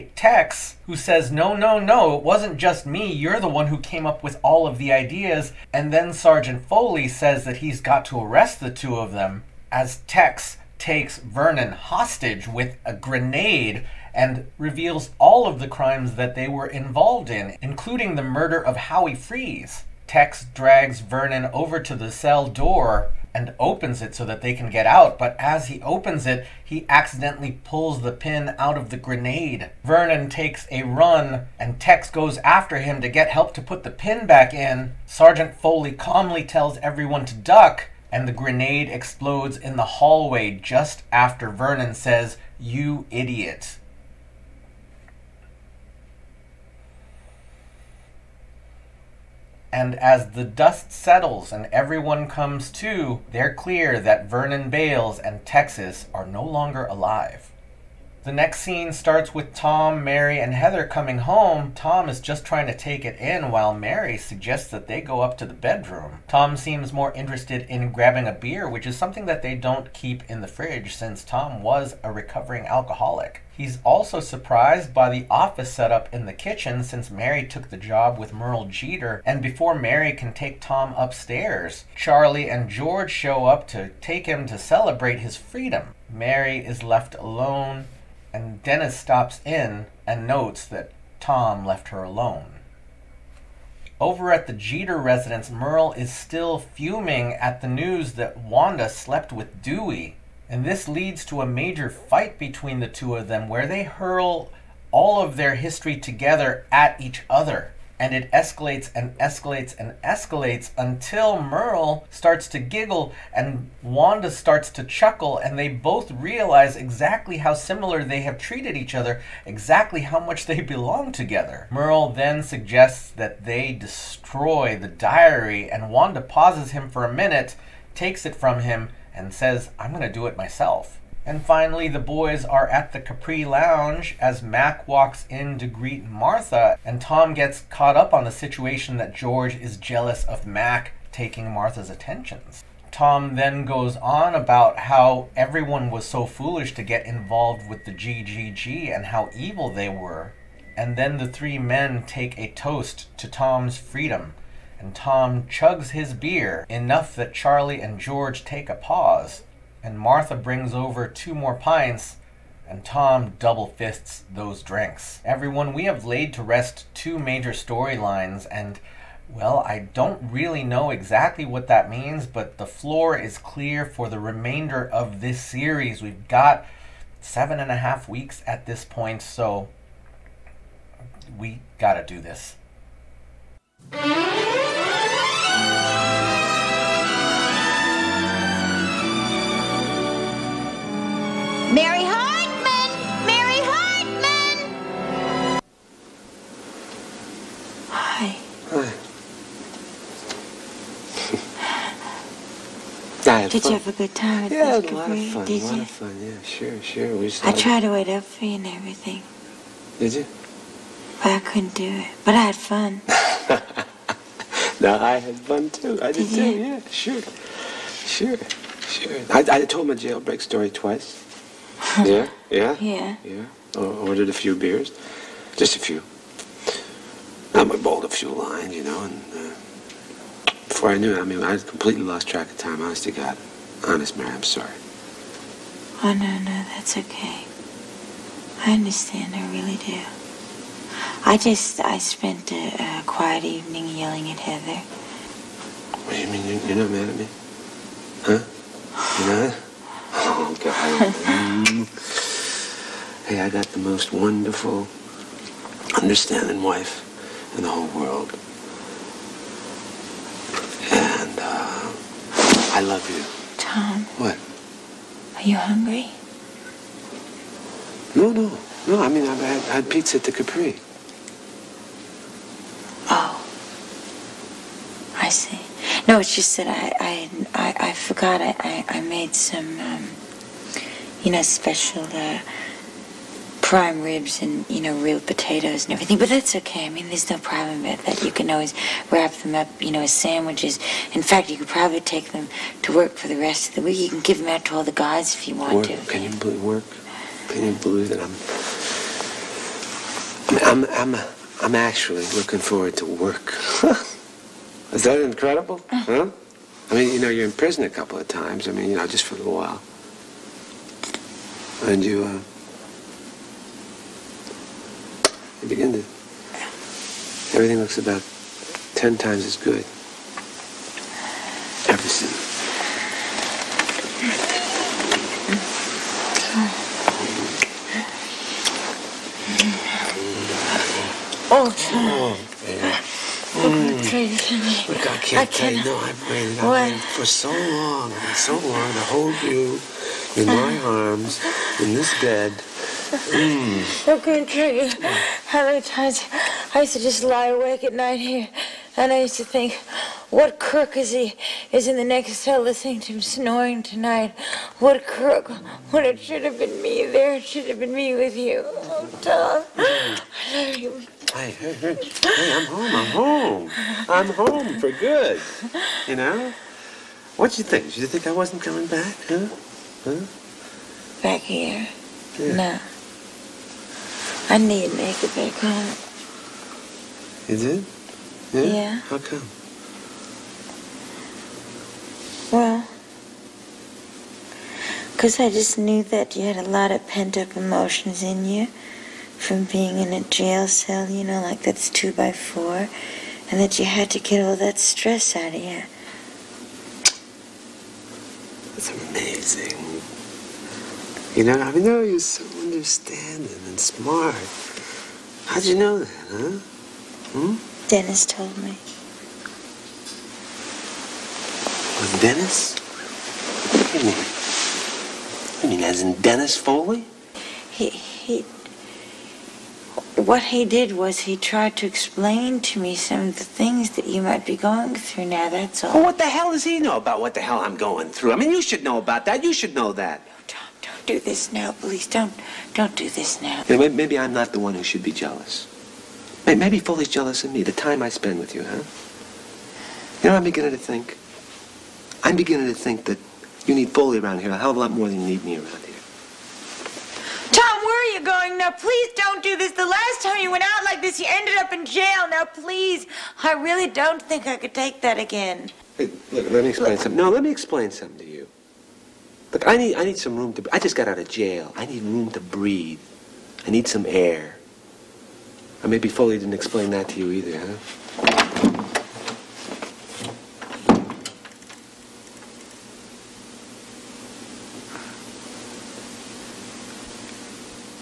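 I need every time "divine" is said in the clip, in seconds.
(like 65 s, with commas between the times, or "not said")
not said.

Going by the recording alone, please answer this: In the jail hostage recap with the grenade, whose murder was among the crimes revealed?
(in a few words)
Howie Freeze.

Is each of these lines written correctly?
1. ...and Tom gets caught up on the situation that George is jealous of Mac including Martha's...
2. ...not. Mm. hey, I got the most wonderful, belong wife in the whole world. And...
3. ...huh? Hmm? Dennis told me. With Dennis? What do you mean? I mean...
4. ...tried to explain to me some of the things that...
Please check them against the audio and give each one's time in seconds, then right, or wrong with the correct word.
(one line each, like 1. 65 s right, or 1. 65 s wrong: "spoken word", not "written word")
1. 136 s wrong: "taking", not "including"
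2. 249 s wrong: "understanding", not "belong"
3. 406 s right
4. 421 s right.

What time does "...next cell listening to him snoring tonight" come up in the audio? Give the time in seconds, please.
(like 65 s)
352 s.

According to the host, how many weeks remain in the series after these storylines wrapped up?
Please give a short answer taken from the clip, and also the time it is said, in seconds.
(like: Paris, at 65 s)
7 and a half, at 177 s.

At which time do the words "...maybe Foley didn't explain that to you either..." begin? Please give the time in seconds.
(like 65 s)
465 s.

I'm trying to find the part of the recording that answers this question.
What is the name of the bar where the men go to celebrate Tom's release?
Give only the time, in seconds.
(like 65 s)
133 s.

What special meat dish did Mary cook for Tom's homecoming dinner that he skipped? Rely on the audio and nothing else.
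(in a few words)
prime ribs.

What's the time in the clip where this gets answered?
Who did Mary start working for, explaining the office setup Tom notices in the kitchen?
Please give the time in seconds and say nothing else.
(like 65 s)
78 s.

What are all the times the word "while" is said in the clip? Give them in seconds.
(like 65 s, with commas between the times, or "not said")
63 s, 309 s.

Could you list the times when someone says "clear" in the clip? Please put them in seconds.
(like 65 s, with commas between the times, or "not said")
53 s, 173 s.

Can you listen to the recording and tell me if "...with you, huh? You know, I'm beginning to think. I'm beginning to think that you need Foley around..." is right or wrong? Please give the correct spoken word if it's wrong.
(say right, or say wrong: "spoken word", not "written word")
right.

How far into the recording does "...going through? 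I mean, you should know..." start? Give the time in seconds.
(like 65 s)
427 s.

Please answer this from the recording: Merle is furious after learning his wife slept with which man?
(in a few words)
Dewey.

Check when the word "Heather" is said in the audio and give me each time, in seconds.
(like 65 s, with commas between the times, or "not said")
60 s, 244 s.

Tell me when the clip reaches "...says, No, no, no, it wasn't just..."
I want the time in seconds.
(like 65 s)
0 s.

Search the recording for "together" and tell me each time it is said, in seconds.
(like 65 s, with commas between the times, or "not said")
105 s, 121 s.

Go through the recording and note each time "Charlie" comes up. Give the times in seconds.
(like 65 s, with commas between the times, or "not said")
81 s, 157 s.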